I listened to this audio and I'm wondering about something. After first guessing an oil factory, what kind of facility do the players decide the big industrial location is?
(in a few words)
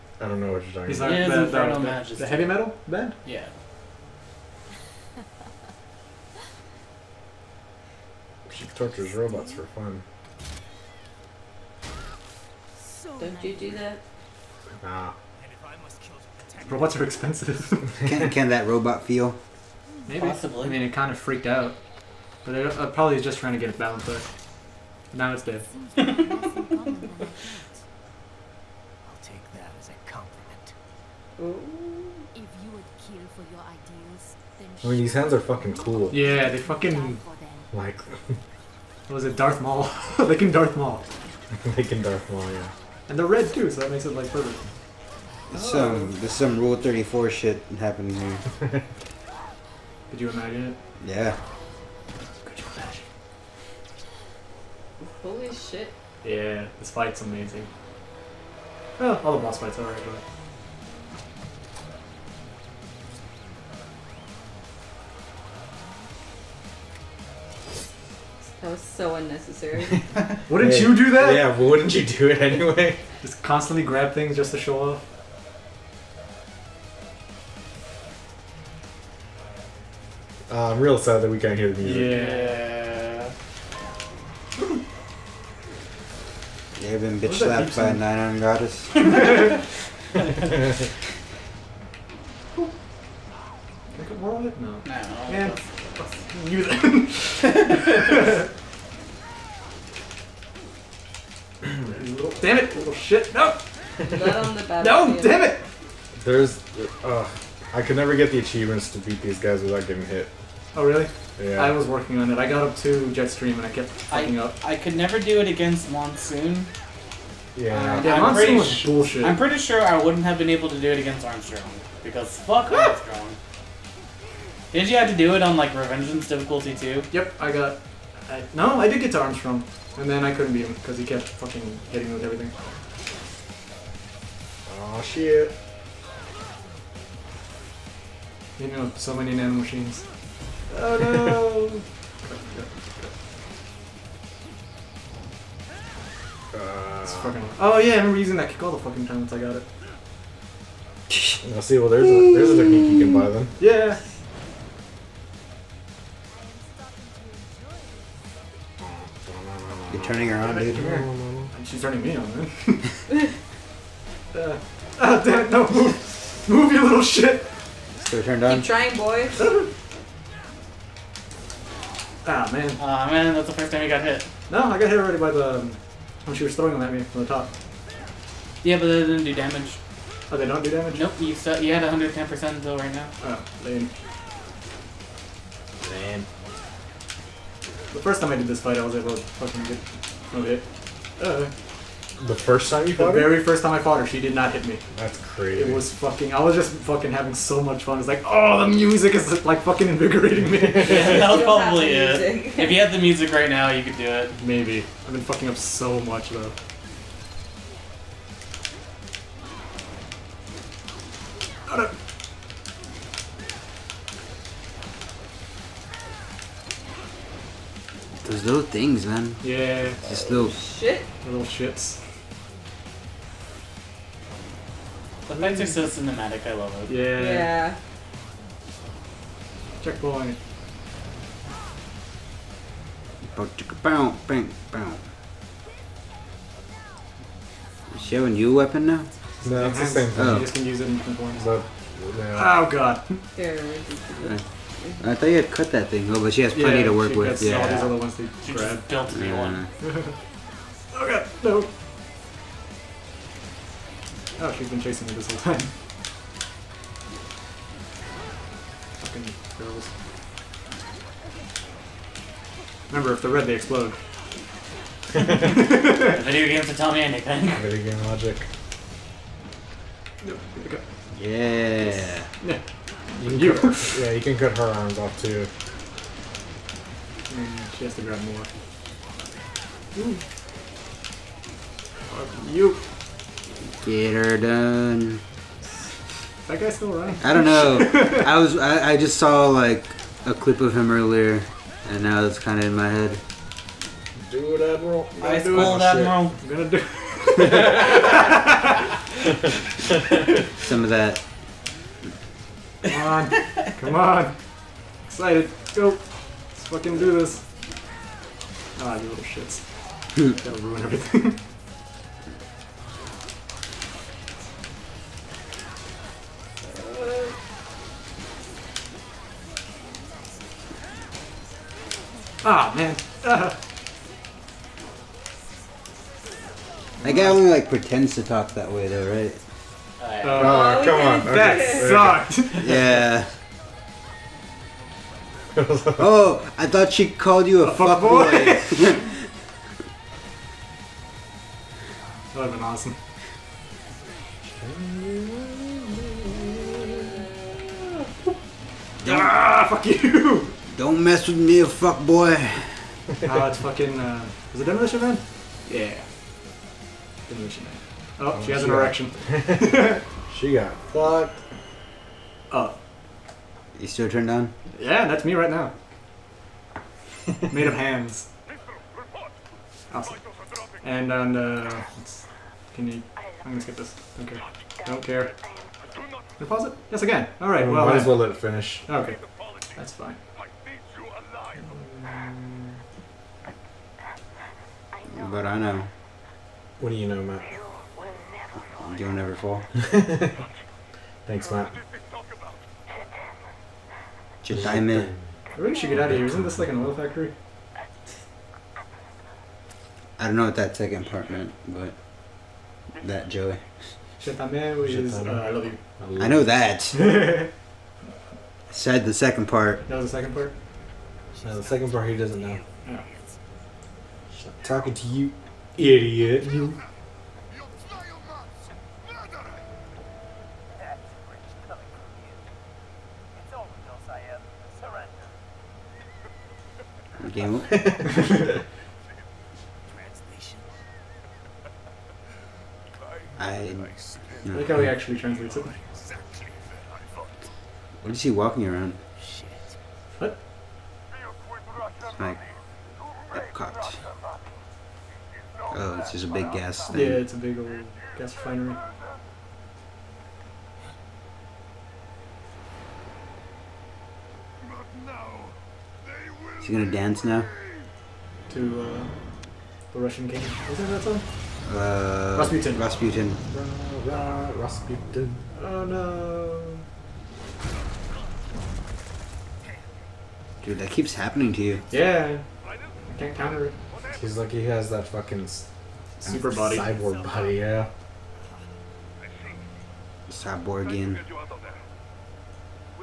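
Gas refinery.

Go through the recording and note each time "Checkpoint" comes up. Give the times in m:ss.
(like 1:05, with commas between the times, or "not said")
3:49.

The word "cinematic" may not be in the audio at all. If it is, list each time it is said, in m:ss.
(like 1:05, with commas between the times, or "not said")
3:45.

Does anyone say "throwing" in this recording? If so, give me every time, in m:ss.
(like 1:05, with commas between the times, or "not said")
2:56.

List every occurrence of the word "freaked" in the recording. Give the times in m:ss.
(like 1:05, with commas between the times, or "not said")
0:21.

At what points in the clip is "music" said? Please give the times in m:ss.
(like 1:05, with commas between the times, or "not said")
1:21, 3:18, 3:22.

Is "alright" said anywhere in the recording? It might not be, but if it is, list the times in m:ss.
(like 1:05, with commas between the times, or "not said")
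0:59, 6:17.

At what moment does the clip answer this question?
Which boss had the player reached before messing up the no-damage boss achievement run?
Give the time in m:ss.
1:53.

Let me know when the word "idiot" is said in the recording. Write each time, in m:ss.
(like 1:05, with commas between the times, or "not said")
6:55.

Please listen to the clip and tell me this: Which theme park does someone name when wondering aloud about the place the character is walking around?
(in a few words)
Epcot.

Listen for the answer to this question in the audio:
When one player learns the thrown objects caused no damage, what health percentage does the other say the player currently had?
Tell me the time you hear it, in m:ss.
3:01.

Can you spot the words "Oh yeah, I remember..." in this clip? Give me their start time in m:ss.
2:27.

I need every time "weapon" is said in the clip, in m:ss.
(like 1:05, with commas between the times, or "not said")
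3:58.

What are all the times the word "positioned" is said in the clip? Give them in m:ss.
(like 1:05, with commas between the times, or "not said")
not said.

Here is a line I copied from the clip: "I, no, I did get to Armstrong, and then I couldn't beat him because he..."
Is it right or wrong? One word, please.
right.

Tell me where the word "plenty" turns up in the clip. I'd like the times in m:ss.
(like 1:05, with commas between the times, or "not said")
4:06.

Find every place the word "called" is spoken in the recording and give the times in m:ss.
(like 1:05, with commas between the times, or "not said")
5:37.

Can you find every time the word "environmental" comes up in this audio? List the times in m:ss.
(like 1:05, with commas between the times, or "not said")
not said.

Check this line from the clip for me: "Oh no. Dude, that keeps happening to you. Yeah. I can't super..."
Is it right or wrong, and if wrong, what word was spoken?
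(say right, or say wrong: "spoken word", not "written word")
wrong: "counter", not "super".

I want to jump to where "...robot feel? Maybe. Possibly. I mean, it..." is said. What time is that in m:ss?
0:18.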